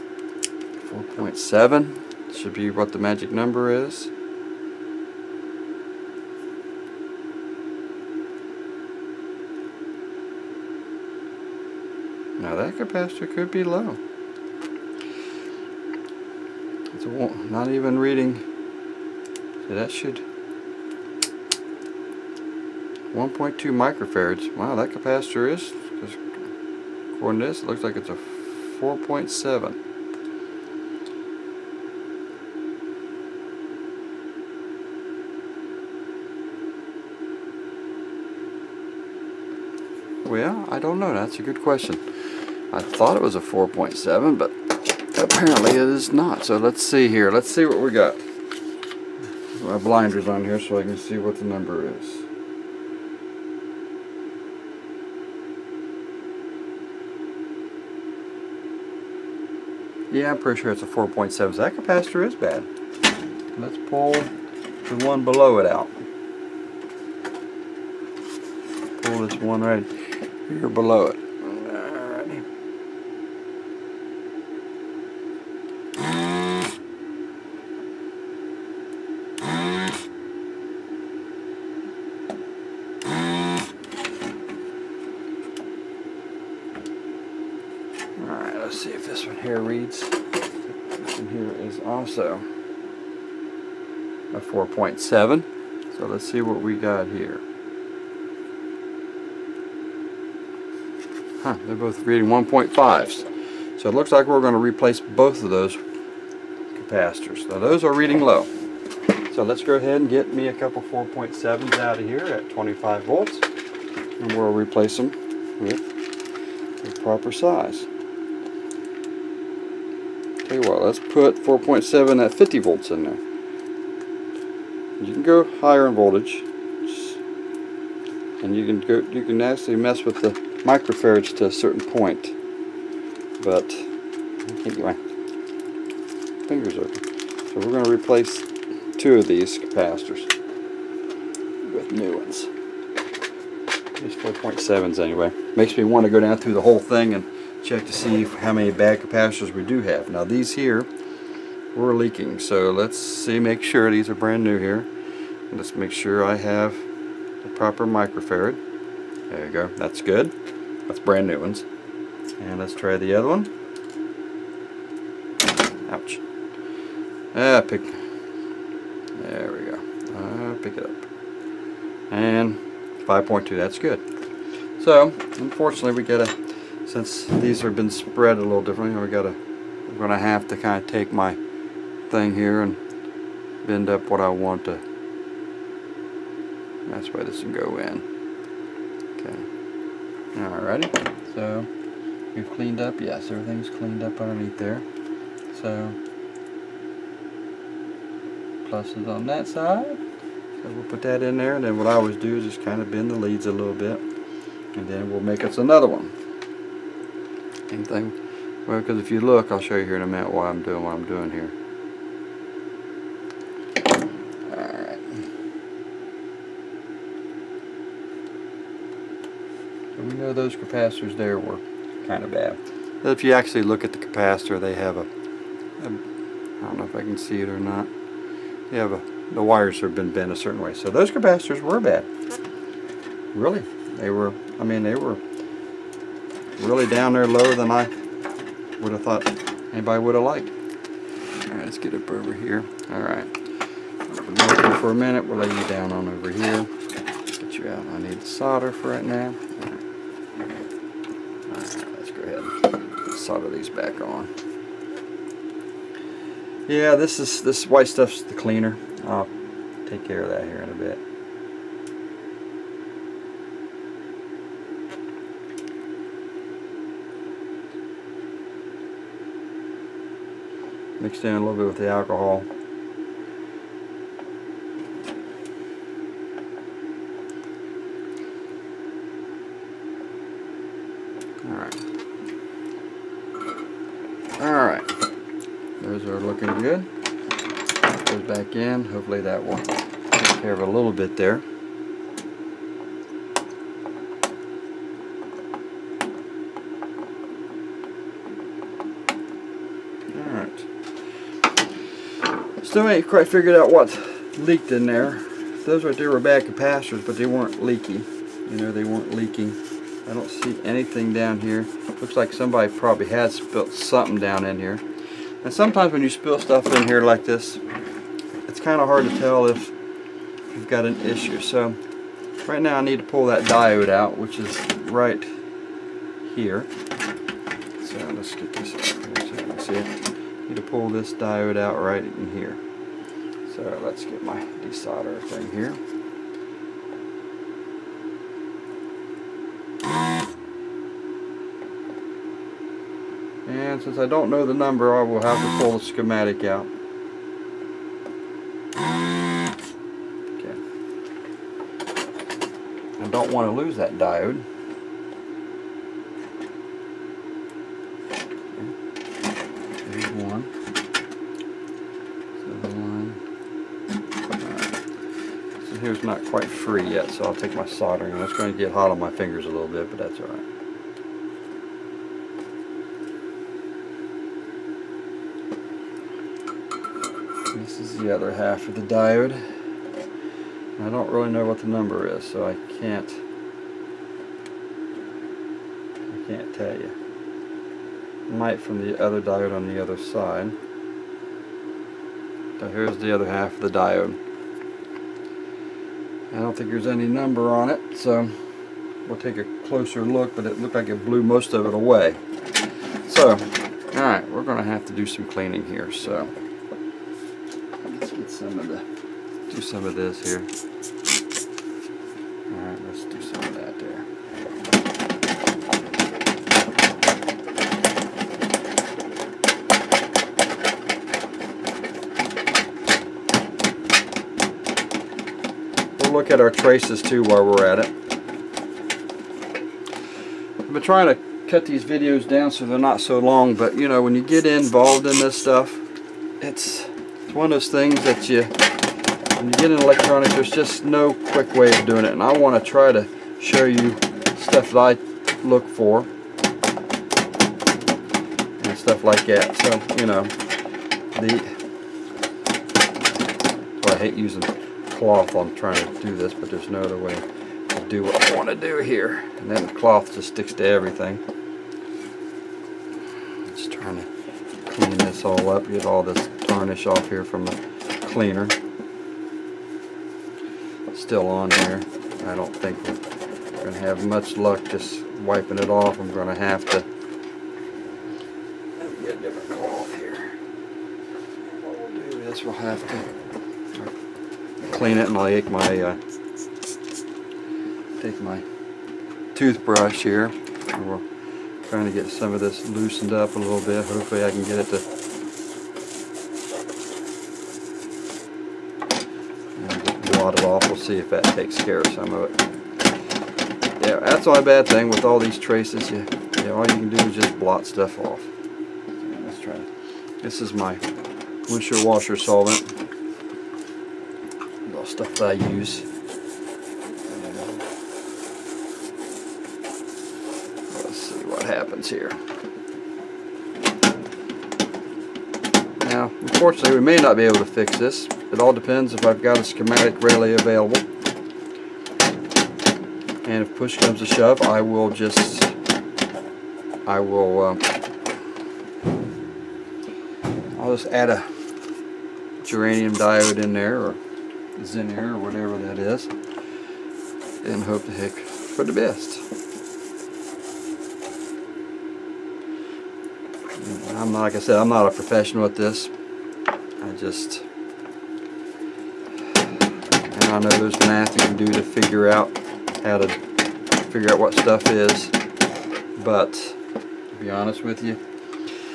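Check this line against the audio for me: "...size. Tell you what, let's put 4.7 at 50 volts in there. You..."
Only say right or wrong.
right.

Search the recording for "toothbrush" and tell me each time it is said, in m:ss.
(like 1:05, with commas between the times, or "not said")
8:09.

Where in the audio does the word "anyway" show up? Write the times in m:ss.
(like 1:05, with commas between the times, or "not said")
2:14, 2:25.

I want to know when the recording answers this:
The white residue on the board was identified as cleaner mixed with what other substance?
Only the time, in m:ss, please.
4:31.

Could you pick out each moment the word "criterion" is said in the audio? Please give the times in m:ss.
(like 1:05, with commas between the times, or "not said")
not said.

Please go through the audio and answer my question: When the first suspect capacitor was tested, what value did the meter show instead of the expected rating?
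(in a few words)
1.2 microfarads.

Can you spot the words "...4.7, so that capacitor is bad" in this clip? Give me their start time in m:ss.
1:00.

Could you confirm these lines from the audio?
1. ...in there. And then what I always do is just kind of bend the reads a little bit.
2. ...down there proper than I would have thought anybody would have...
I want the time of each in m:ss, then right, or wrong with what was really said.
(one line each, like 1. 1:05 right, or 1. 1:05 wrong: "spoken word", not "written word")
1. 3:21 wrong: "leads", not "reads"
2. 3:56 wrong: "lower", not "proper".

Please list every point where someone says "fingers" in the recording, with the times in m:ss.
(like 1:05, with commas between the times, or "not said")
2:16, 6:09.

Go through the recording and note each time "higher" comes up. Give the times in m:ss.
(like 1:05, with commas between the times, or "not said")
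2:05.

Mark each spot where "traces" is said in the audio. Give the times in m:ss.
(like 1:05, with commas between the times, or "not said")
7:06, 8:25.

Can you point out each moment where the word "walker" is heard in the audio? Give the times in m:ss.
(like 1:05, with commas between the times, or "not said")
not said.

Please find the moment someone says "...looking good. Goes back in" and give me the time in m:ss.
4:46.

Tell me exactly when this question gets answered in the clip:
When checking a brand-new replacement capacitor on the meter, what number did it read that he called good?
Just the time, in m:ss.
2:53.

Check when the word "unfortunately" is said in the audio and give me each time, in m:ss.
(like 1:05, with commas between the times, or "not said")
2:55, 8:46.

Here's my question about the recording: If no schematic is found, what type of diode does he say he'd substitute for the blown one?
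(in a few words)
germanium diode.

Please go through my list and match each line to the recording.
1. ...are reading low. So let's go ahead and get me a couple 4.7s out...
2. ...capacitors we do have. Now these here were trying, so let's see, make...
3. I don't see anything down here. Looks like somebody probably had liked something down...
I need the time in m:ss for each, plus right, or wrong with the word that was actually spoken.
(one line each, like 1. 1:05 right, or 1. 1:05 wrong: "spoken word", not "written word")
1. 1:47 right
2. 2:28 wrong: "leaking", not "trying"
3. 5:10 wrong: "spilled", not "liked".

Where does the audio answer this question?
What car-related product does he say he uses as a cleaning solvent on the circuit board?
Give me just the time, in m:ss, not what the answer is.
8:31.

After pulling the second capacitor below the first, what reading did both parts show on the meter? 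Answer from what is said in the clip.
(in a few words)
1.5.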